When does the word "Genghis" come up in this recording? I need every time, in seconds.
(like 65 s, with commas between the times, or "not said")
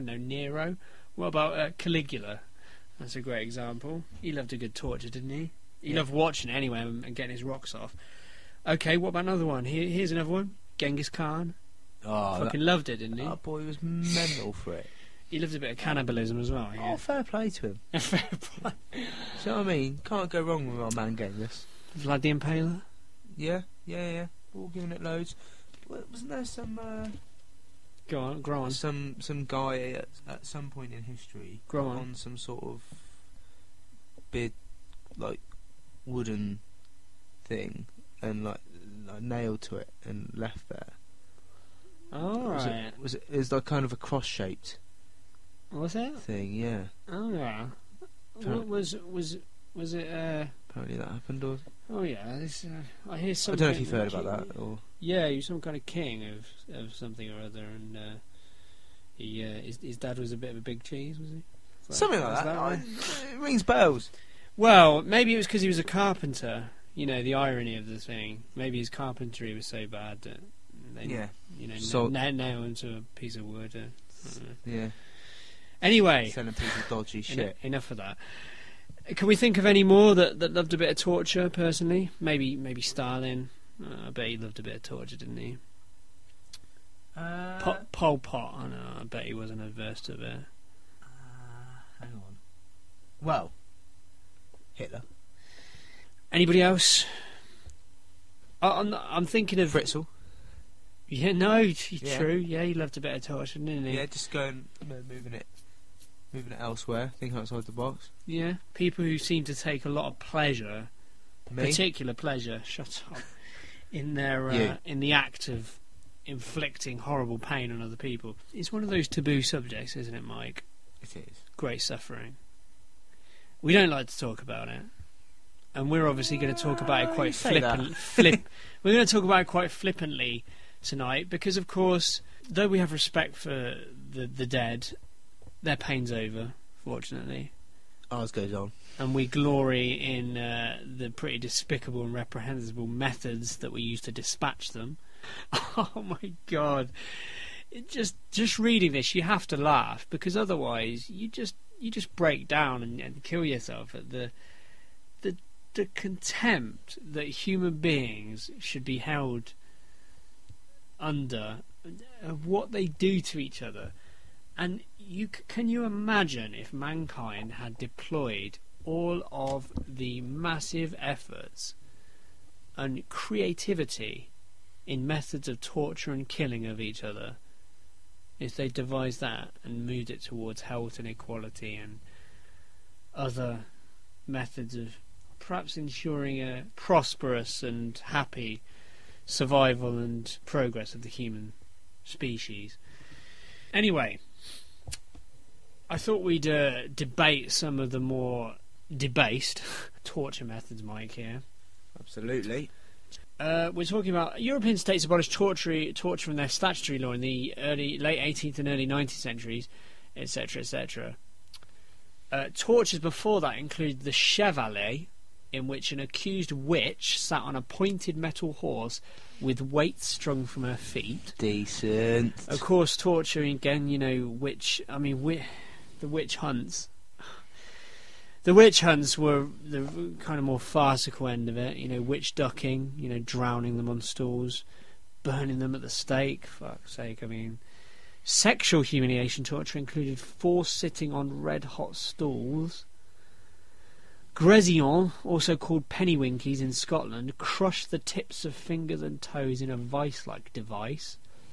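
10 s, 21 s.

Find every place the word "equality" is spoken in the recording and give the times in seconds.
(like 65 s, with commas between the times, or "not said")
181 s.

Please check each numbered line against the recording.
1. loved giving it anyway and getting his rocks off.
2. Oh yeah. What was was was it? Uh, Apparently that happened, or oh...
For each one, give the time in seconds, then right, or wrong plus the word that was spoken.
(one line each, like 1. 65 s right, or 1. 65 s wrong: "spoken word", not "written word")
1. 5 s wrong: "watching", not "giving"
2. 47 s right.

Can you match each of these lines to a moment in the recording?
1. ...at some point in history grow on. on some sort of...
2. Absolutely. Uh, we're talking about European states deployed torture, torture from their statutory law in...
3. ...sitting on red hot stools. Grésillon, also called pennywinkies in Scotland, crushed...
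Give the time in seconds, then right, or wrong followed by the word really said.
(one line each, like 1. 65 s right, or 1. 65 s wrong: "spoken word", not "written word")
1. 30 s right
2. 201 s wrong: "abolished", not "deployed"
3. 240 s right.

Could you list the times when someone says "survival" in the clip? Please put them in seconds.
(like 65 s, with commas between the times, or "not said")
189 s.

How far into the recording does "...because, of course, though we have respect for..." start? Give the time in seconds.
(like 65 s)
131 s.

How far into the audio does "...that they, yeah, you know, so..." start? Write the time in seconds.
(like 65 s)
70 s.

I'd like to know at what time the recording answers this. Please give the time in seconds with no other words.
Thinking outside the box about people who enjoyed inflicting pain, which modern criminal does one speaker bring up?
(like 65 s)
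99 s.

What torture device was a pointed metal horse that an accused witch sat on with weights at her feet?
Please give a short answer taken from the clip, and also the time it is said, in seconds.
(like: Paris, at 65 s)
The chevalet, at 214 s.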